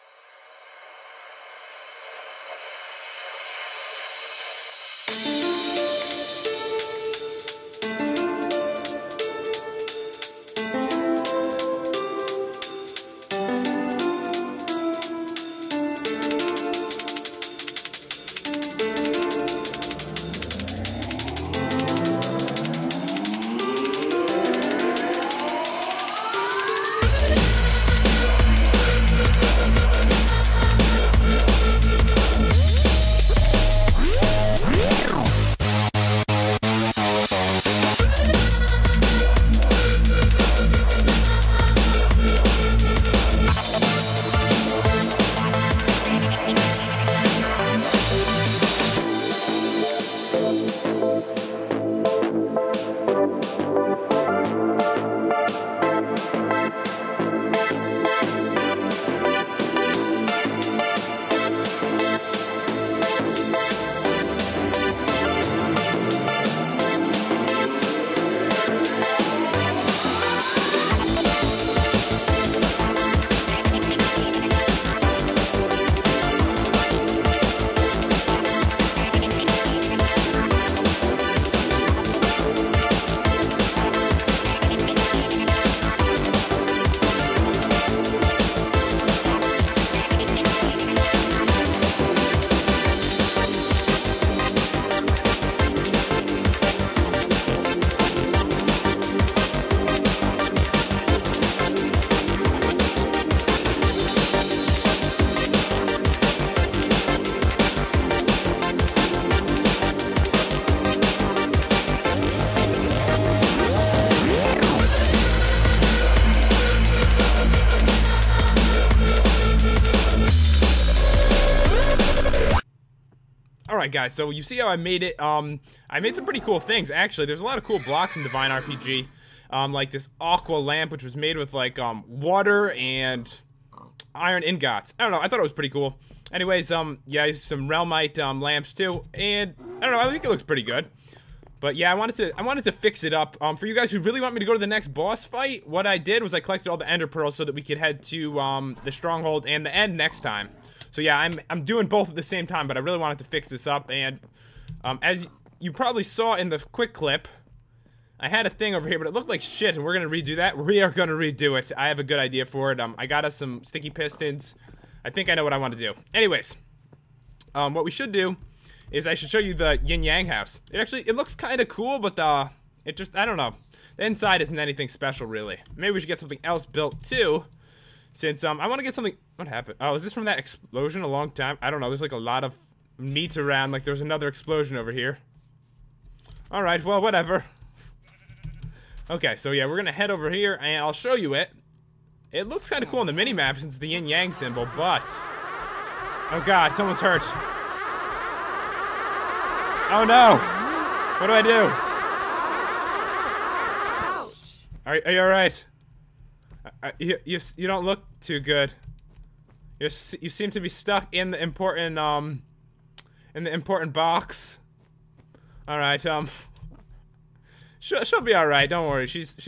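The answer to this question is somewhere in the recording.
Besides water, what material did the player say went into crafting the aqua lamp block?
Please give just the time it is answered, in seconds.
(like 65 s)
134 s.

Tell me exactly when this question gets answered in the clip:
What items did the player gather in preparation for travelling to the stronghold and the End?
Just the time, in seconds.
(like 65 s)
146 s.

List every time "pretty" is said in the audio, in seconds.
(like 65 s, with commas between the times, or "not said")
126 s, 135 s, 140 s.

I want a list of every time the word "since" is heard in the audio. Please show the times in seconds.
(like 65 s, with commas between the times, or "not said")
178 s, 193 s.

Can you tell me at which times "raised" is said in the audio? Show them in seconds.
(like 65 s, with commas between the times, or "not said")
not said.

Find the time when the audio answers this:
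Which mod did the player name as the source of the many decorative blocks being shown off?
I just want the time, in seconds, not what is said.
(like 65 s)
128 s.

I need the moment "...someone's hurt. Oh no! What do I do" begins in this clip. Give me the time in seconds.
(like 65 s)
196 s.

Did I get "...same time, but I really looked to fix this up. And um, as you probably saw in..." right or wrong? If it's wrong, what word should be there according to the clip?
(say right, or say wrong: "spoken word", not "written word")
wrong: "wanted", not "looked".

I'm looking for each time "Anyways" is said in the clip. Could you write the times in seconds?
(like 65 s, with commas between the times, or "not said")
136 s, 166 s.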